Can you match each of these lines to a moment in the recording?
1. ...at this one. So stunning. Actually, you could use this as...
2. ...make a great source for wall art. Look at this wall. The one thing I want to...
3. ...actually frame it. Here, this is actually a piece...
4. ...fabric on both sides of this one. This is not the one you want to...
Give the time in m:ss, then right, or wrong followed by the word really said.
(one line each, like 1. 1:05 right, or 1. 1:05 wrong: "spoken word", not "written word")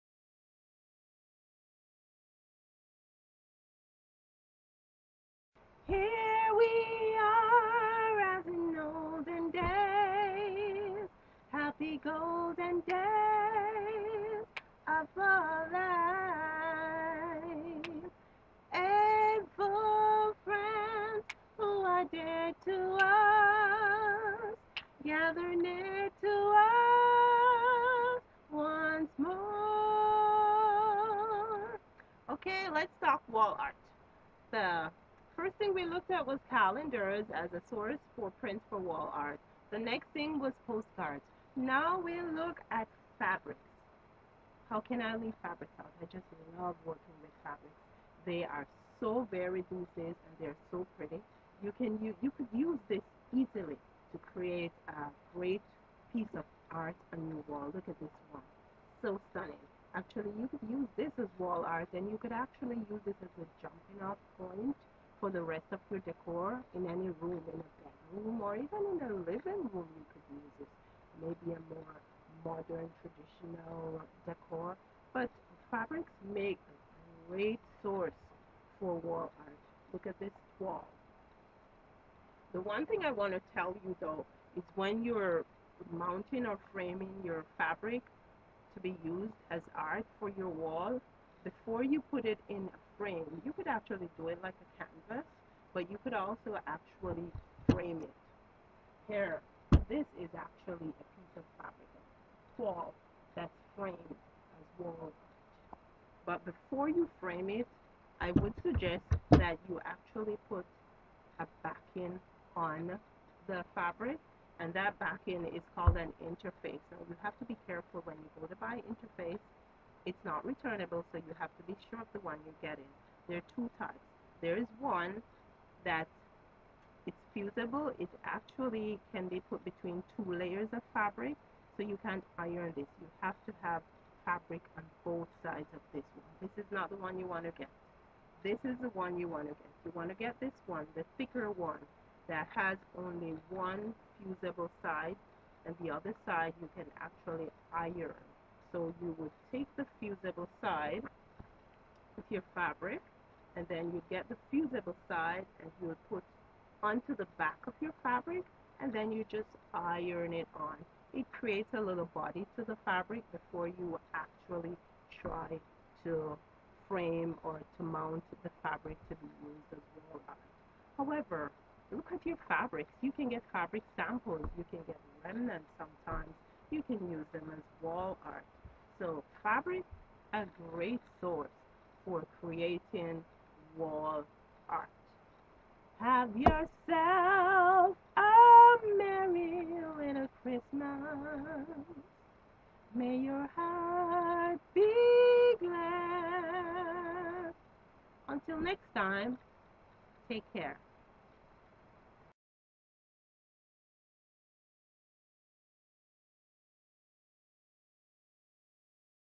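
1. 0:57 right
2. 1:16 right
3. 1:36 right
4. 2:14 right.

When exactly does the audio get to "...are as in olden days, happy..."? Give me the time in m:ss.
0:07.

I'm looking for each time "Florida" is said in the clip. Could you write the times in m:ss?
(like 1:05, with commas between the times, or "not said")
not said.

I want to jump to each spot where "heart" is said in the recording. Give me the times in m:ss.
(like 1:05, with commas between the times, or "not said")
3:13.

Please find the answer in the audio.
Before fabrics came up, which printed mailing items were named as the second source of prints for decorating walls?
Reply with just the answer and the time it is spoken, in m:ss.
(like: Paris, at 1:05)
Postcards, at 0:40.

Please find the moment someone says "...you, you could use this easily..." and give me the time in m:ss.
0:52.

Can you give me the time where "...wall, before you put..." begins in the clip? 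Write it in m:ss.
1:30.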